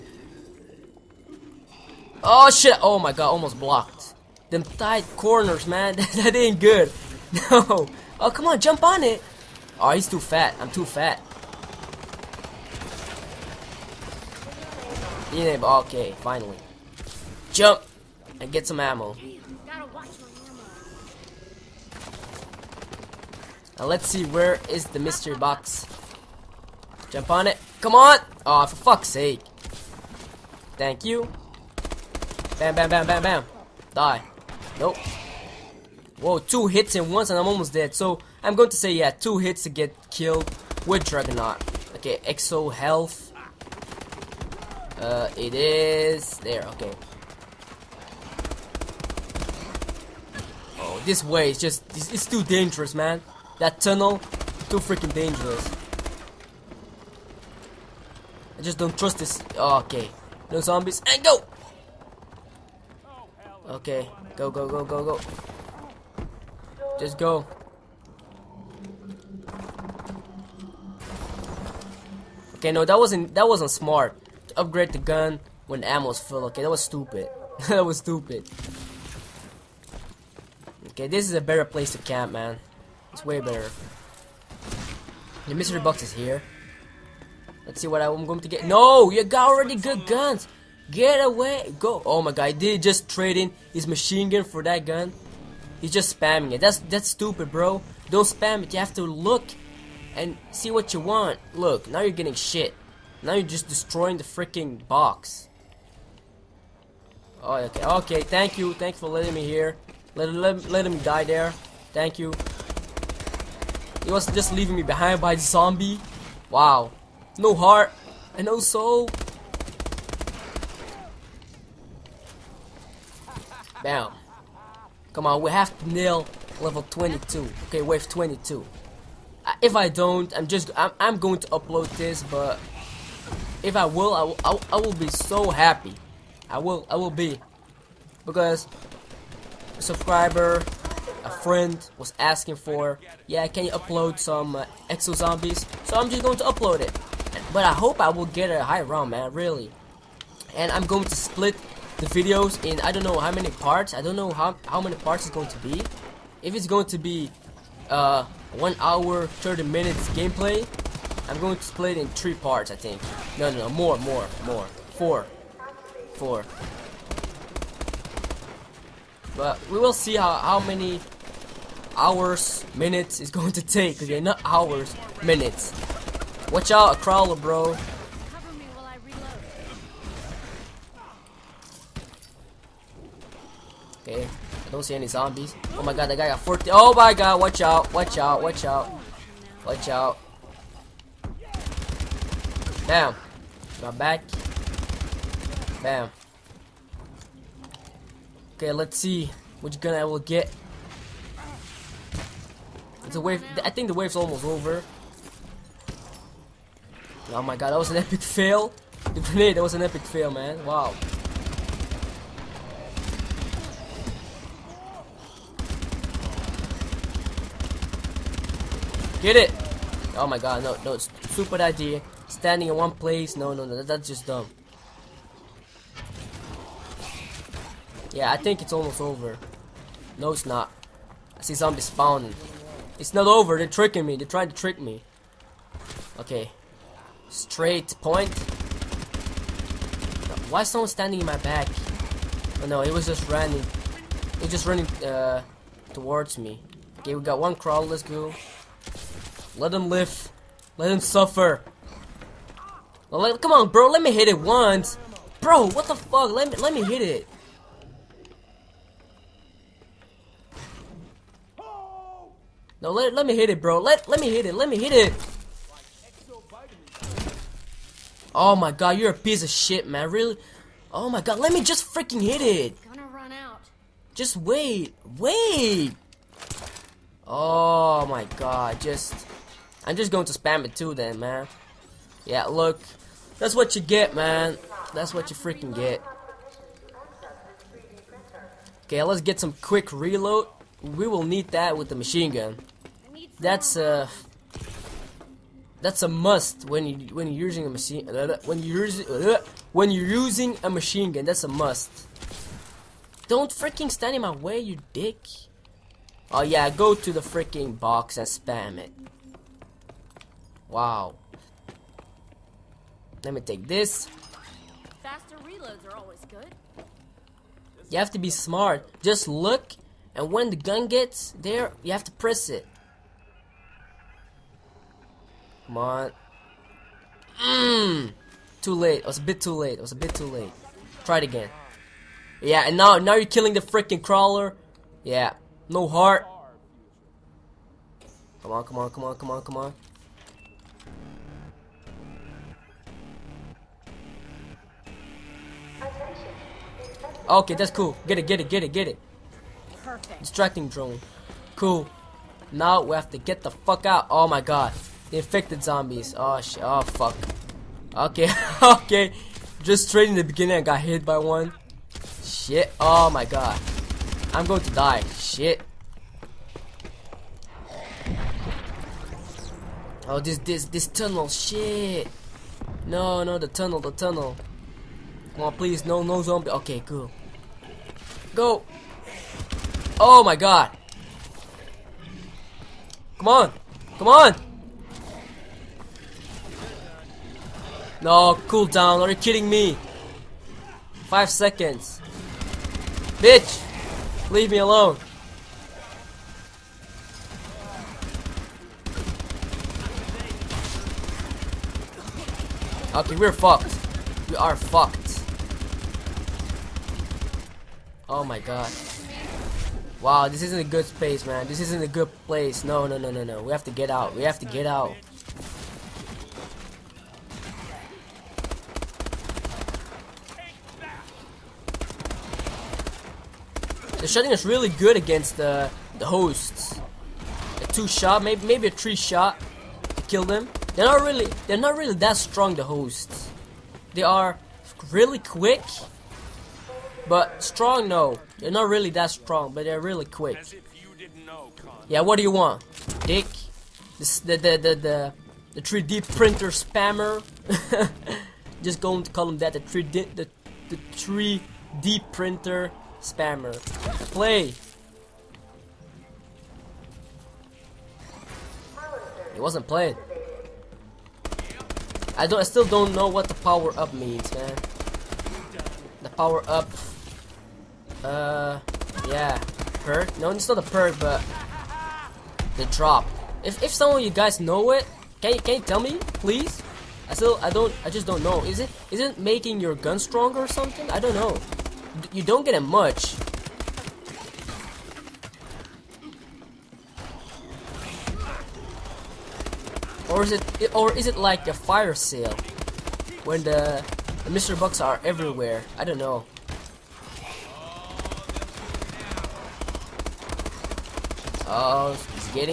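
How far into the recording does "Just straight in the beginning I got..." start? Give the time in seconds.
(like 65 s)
359 s.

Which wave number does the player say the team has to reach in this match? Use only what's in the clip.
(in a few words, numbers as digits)
22.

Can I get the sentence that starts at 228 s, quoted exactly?
Yeah, I think it's almost over.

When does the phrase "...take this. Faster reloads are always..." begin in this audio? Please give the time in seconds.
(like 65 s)
313 s.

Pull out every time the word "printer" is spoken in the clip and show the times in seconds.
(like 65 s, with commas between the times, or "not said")
446 s, 452 s.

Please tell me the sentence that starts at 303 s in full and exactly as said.
Don't freaking stand in my way, you dick.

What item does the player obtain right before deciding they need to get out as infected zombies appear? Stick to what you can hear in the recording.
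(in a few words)
Distracting drone.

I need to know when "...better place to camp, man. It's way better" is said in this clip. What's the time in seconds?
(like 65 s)
81 s.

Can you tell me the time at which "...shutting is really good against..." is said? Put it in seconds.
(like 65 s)
424 s.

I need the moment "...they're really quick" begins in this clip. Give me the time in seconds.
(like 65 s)
439 s.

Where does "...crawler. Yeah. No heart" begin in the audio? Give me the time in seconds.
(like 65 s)
334 s.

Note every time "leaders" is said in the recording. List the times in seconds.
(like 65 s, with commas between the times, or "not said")
not said.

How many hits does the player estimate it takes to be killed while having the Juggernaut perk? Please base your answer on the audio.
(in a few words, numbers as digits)
2.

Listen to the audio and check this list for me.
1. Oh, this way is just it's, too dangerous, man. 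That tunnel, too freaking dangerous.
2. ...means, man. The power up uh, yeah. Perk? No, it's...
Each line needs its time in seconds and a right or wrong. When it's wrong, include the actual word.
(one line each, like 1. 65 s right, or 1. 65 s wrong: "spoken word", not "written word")
1. 50 s right
2. 463 s right.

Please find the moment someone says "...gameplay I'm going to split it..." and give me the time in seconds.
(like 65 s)
160 s.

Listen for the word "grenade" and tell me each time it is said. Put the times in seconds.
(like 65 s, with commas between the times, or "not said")
209 s.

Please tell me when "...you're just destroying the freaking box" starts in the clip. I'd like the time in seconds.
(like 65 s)
103 s.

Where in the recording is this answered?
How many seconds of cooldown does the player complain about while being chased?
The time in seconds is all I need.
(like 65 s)
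391 s.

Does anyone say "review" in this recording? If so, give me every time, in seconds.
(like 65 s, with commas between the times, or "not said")
not said.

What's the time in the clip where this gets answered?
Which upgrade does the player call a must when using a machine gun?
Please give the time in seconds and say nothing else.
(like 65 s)
289 s.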